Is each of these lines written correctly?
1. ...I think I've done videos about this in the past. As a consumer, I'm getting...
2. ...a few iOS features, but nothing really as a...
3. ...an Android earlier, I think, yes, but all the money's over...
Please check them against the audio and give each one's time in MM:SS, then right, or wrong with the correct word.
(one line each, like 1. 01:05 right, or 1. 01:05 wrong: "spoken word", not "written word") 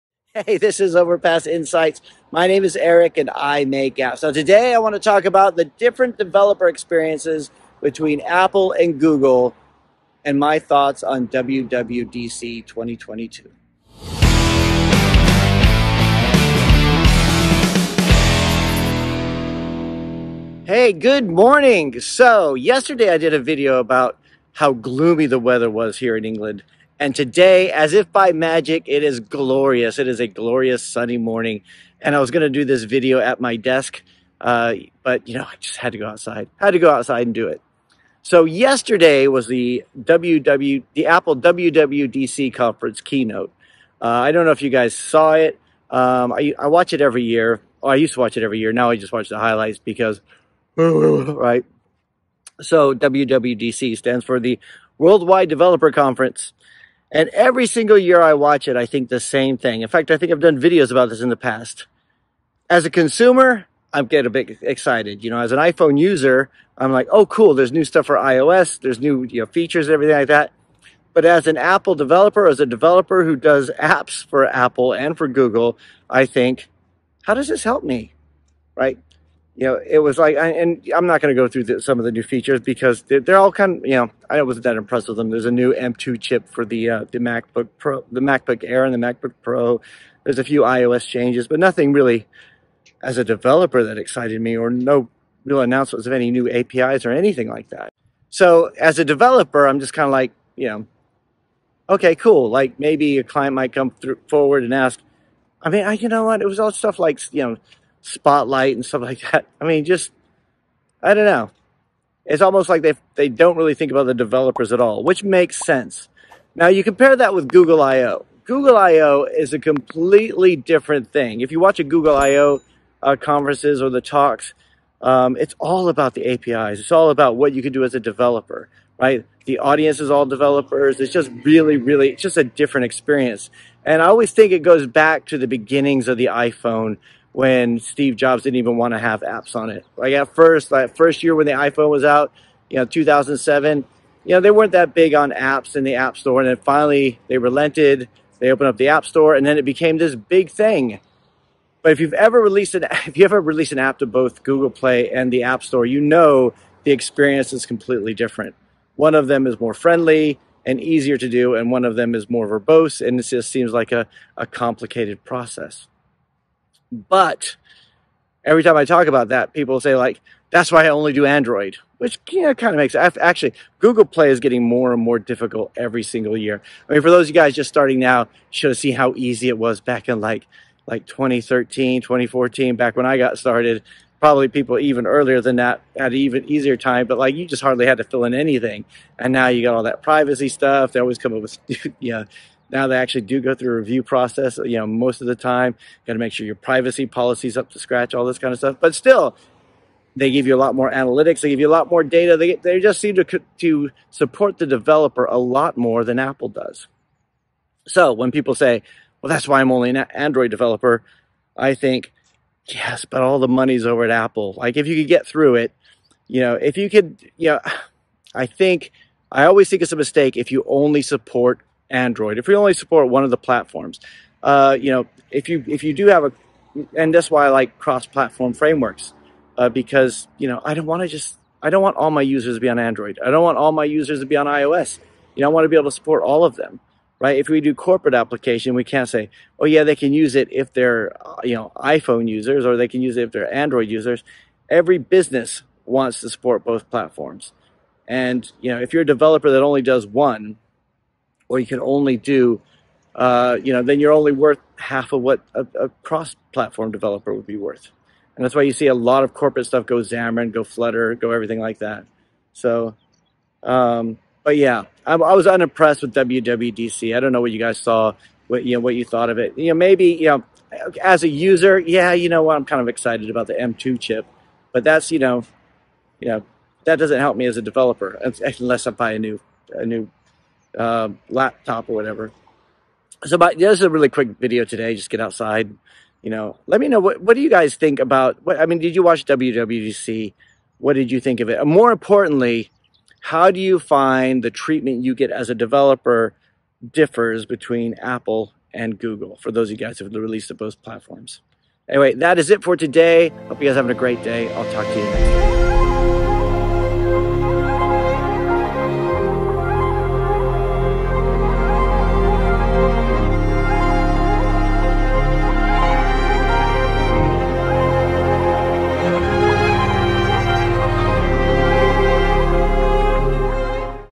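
1. 01:00 right
2. 01:30 wrong: "changes", not "features"
3. 03:29 wrong: "developer", not "earlier".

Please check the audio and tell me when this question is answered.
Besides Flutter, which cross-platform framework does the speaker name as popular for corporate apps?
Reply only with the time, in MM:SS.
04:19.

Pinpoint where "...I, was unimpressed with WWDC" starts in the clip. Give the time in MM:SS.
04:25.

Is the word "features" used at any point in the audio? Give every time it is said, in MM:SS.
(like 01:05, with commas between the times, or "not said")
01:09, 01:22.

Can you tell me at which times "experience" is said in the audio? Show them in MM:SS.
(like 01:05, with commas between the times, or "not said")
00:06, 02:12, 02:36.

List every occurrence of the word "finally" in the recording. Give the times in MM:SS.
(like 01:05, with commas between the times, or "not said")
02:26.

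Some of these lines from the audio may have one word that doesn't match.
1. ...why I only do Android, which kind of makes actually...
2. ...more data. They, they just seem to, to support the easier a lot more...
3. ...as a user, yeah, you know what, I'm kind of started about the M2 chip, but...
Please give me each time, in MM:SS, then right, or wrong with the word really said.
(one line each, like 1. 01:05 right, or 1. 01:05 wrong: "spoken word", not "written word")
1. 02:50 right
2. 03:21 wrong: "developer", not "easier"
3. 04:31 wrong: "excited", not "started".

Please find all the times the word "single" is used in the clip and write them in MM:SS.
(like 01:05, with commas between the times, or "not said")
00:57, 02:56.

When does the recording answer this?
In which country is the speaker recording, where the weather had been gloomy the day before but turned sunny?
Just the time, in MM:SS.
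00:26.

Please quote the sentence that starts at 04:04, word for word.
Every business wants to support both platforms.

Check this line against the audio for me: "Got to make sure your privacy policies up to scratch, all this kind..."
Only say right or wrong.
right.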